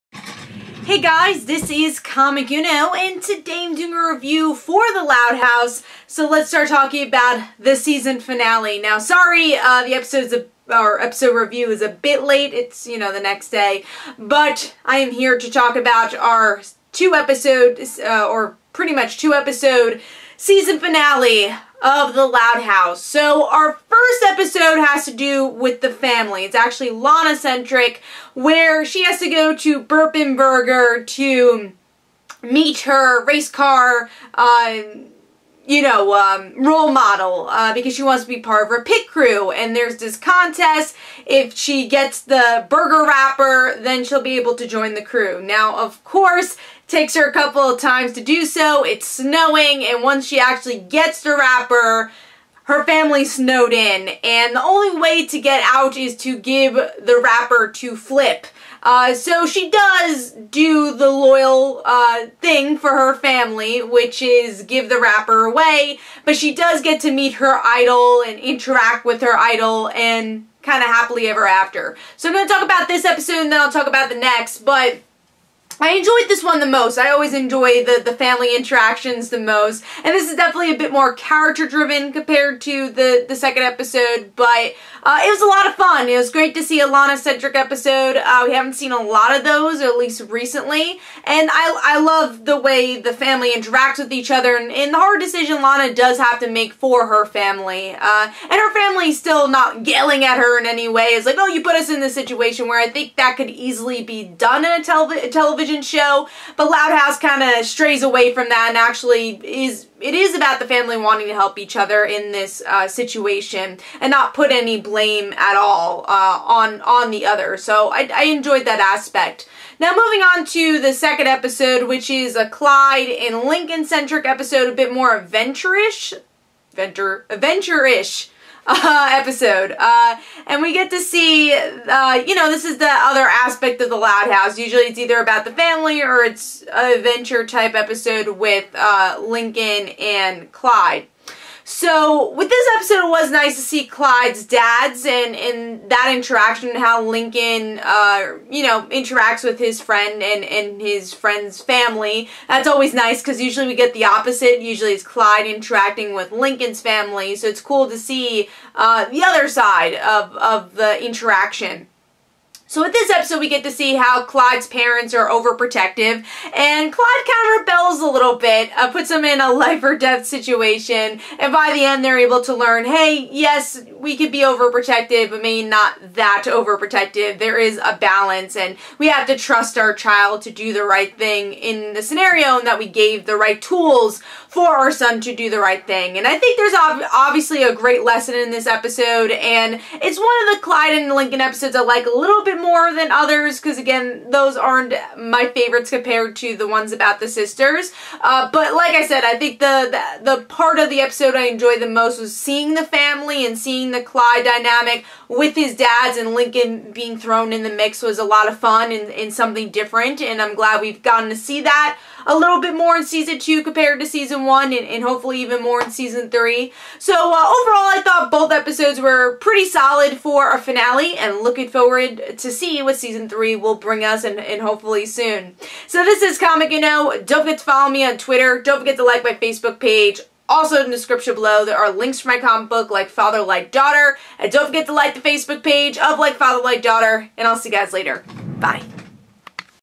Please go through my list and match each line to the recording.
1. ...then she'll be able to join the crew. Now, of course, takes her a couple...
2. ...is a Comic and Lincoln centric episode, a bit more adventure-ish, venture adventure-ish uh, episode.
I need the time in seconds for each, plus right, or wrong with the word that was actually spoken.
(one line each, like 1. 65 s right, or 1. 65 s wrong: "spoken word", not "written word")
1. 43 s right
2. 122 s wrong: "Clyde", not "Comic".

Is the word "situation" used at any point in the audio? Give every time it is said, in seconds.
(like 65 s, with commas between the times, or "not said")
102 s, 112 s, 170 s.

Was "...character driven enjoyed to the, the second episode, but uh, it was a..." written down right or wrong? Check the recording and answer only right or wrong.
wrong.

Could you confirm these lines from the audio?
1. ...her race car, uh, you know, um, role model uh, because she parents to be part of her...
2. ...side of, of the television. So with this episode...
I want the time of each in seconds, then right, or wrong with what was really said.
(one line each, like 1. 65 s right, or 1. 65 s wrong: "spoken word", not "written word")
1. 32 s wrong: "wants", not "parents"
2. 159 s wrong: "interaction", not "television".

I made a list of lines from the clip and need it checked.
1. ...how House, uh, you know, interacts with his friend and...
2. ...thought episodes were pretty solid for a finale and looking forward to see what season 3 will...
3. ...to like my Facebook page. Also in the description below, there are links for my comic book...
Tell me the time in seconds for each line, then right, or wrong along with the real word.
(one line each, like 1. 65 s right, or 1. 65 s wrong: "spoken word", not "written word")
1. 146 s wrong: "Lincoln", not "House"
2. 218 s right
3. 228 s right.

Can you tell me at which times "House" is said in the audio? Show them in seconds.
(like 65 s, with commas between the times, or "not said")
5 s, 22 s, 106 s, 134 s.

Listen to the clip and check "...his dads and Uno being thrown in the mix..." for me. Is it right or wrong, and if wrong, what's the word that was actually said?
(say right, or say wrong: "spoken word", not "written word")
wrong: "Lincoln", not "Uno".